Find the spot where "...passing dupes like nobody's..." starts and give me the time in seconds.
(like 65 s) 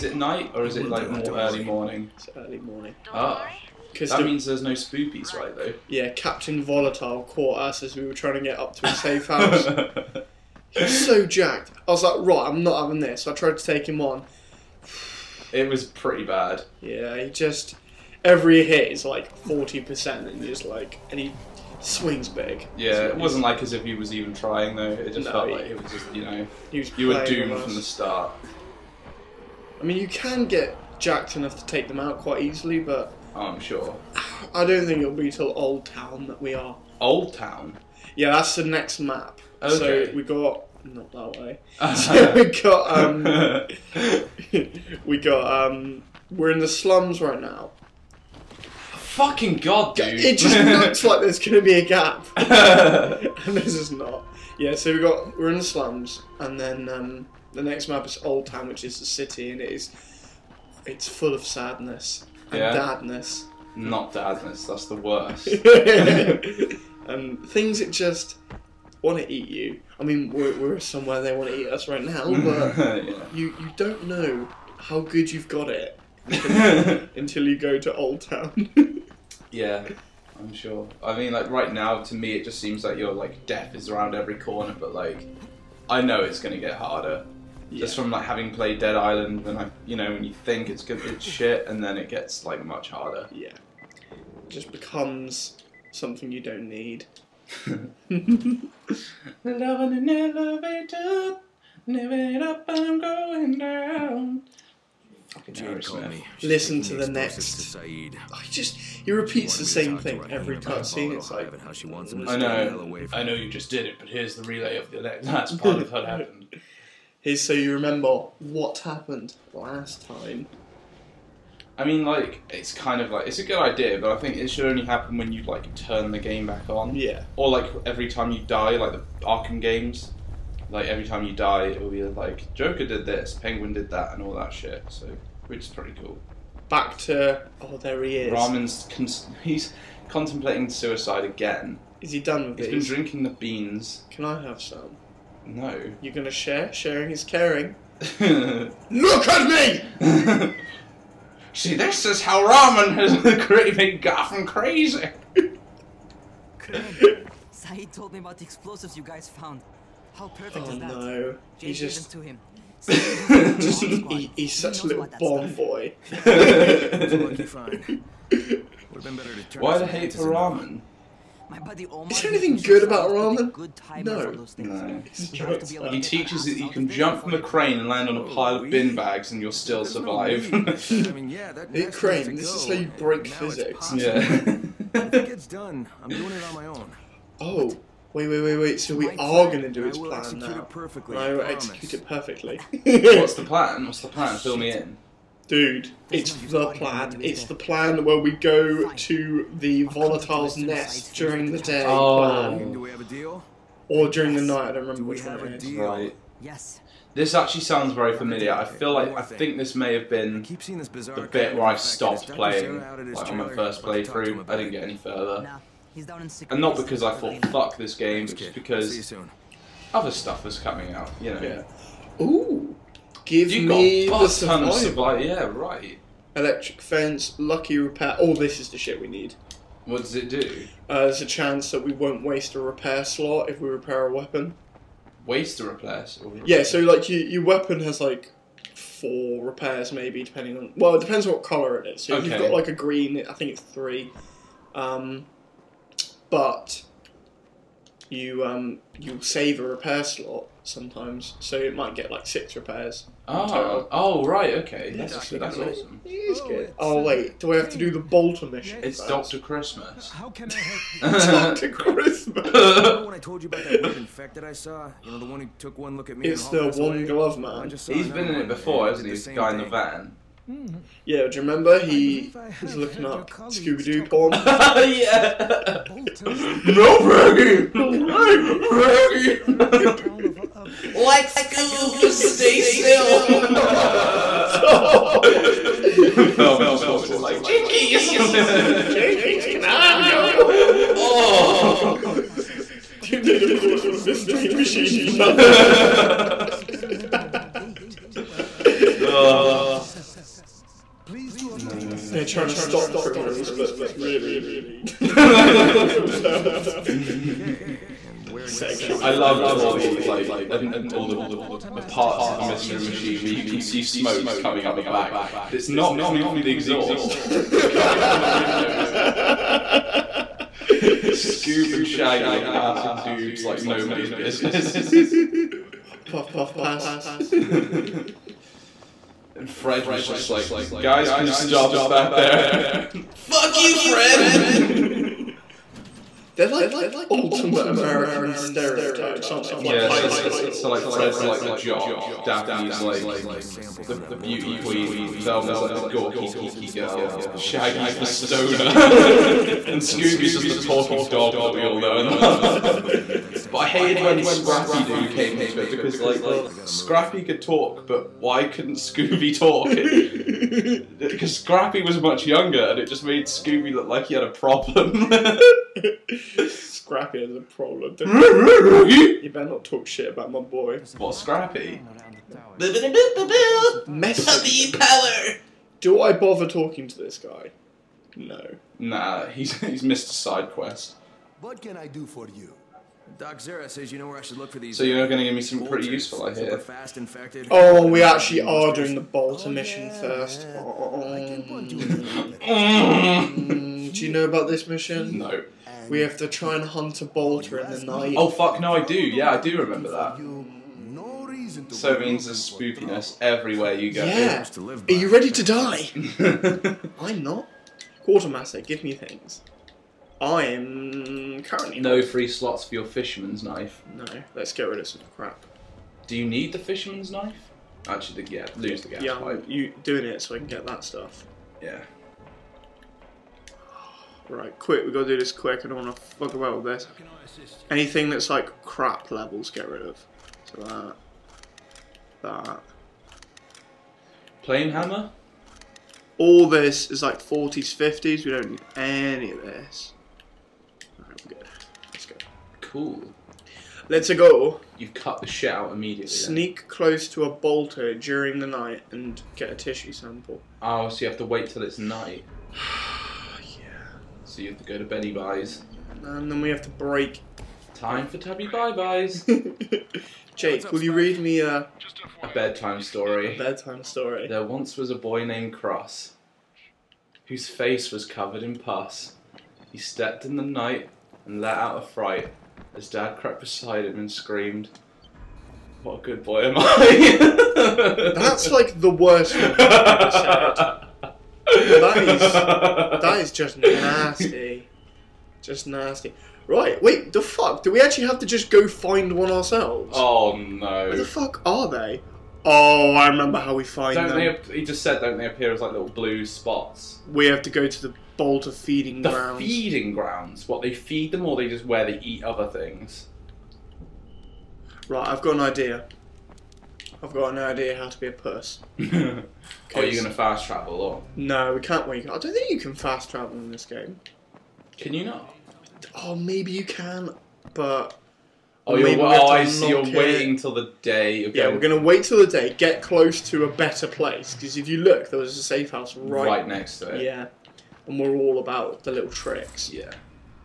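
322 s.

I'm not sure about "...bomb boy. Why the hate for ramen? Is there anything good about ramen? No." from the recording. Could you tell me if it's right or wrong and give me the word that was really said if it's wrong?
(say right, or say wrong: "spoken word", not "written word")
right.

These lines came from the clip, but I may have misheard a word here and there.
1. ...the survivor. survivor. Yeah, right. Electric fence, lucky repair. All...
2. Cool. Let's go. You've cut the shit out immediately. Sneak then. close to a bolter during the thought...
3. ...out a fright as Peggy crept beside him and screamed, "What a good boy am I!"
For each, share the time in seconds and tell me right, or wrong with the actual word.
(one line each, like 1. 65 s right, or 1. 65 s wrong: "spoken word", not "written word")
1. 224 s right
2. 442 s wrong: "night", not "thought"
3. 471 s wrong: "Dad", not "Peggy".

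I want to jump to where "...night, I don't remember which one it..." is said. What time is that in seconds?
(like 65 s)
204 s.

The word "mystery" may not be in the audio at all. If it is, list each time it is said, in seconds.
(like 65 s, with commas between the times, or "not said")
294 s, 312 s.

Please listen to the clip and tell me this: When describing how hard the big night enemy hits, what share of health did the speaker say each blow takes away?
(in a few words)
40%.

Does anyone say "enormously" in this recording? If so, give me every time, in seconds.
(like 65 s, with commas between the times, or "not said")
not said.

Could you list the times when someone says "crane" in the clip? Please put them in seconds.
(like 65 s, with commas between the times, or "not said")
177 s, 181 s.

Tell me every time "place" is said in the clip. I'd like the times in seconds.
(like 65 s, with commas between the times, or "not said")
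523 s.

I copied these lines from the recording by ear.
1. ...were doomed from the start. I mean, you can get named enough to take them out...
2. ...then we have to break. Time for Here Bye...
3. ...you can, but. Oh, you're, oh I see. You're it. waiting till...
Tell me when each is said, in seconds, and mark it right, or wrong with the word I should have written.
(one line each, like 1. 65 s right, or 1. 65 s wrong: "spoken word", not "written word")
1. 27 s wrong: "jacked", not "named"
2. 456 s wrong: "Tabby", not "Here"
3. 516 s right.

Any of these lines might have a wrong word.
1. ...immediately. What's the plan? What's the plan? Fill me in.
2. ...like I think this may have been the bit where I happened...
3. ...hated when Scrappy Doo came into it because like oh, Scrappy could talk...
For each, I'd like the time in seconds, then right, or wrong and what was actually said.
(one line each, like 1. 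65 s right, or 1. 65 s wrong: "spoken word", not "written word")
1. 192 s wrong: "perfectly", not "immediately"
2. 208 s wrong: "stopped", not "happened"
3. 353 s right.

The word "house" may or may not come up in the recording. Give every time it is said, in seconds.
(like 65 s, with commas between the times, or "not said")
9 s, 525 s.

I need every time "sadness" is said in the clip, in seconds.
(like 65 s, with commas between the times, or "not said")
61 s.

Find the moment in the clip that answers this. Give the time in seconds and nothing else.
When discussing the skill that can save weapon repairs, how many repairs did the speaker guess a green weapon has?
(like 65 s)
243 s.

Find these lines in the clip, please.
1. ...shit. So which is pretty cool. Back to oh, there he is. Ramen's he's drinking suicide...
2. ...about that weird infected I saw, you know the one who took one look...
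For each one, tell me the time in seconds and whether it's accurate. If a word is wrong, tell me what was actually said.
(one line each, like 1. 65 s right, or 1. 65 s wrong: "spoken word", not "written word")
1. 134 s wrong: "contemplating", not "drinking"
2. 263 s right.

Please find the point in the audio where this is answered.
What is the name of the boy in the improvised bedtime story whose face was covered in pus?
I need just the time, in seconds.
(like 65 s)
465 s.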